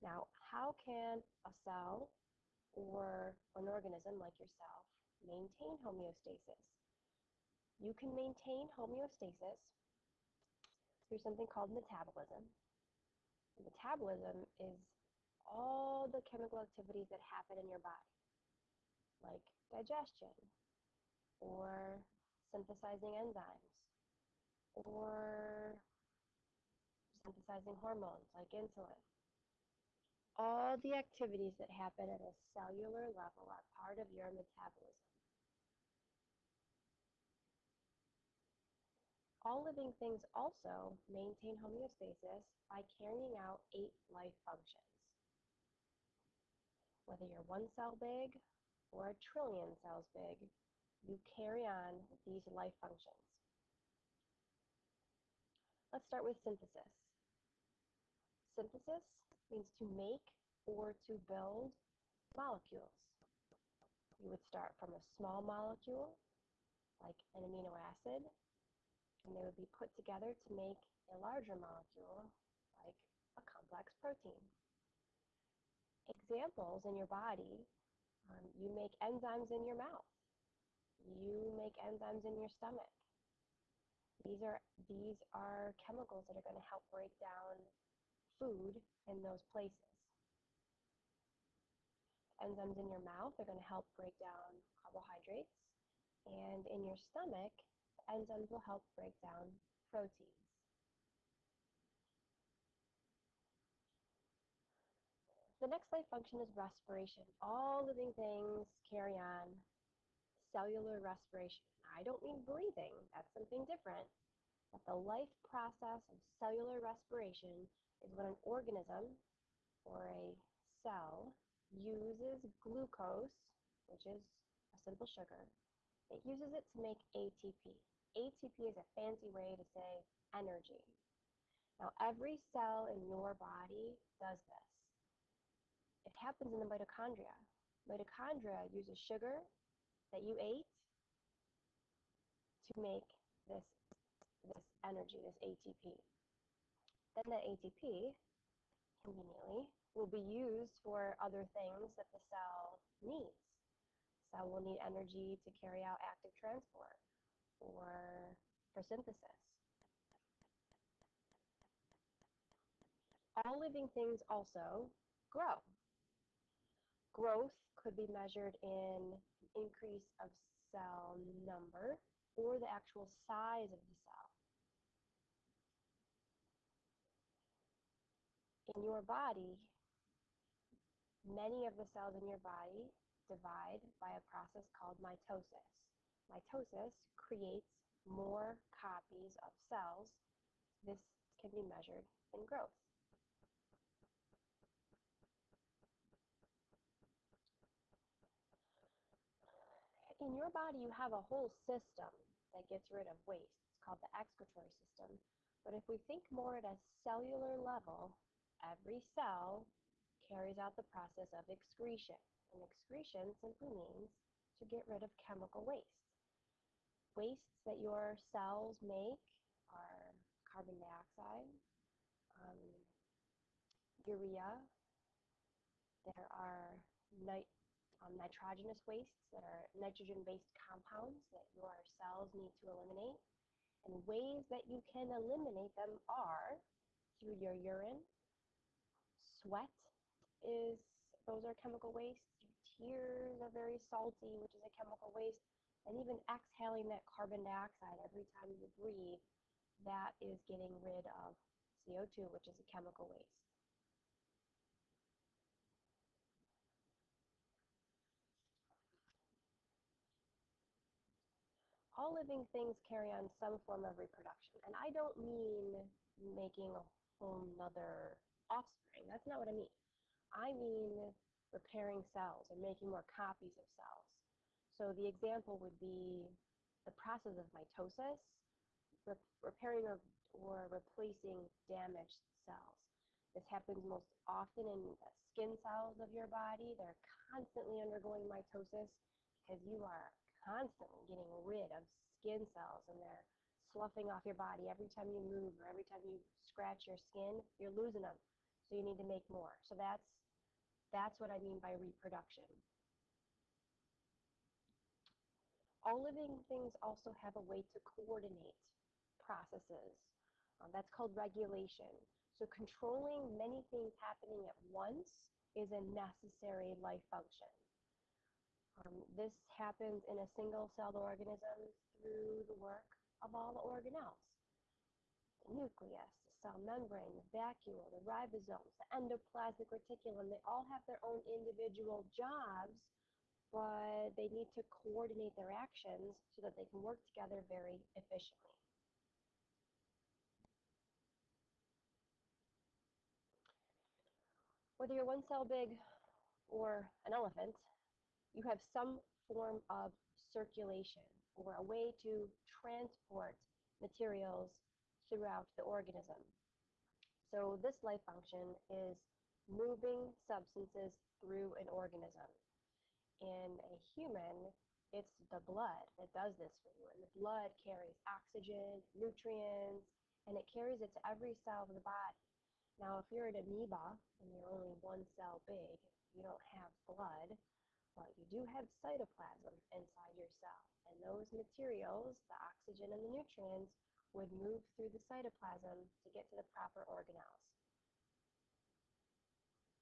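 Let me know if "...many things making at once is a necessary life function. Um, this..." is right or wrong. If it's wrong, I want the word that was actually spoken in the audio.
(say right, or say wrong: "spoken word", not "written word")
wrong: "happening", not "making".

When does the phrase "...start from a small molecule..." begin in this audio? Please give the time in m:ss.
1:04.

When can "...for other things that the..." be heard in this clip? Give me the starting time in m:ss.
2:30.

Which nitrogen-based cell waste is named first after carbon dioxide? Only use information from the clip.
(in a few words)
urea.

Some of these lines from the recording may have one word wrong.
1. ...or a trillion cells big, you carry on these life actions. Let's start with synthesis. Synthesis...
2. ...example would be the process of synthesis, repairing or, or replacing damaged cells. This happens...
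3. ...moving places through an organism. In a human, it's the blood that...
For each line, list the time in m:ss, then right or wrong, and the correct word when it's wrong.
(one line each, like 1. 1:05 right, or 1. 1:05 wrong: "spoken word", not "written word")
1. 0:48 wrong: "functions", not "actions"
2. 4:35 wrong: "mitosis", not "synthesis"
3. 5:59 wrong: "substances", not "places".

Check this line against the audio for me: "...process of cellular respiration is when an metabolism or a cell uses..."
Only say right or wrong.
wrong.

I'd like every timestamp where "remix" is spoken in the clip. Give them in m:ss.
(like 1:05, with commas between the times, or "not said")
not said.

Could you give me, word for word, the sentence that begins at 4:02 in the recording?
Your tears are very salty, which is a chemical waste.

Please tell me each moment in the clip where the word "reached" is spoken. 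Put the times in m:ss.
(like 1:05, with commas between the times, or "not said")
not said.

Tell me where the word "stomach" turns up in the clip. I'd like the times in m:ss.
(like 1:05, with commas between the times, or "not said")
1:22, 1:36.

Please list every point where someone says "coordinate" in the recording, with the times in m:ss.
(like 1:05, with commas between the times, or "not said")
5:07, 5:34.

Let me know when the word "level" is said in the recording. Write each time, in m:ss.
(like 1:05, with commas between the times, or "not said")
0:33, 3:27.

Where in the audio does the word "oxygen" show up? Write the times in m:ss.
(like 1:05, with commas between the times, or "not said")
6:08, 6:22.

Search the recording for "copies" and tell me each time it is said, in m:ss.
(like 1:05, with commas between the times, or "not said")
3:08, 4:33.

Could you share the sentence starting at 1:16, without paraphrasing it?
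Examples in your body, um, you make enzymes in your mouth.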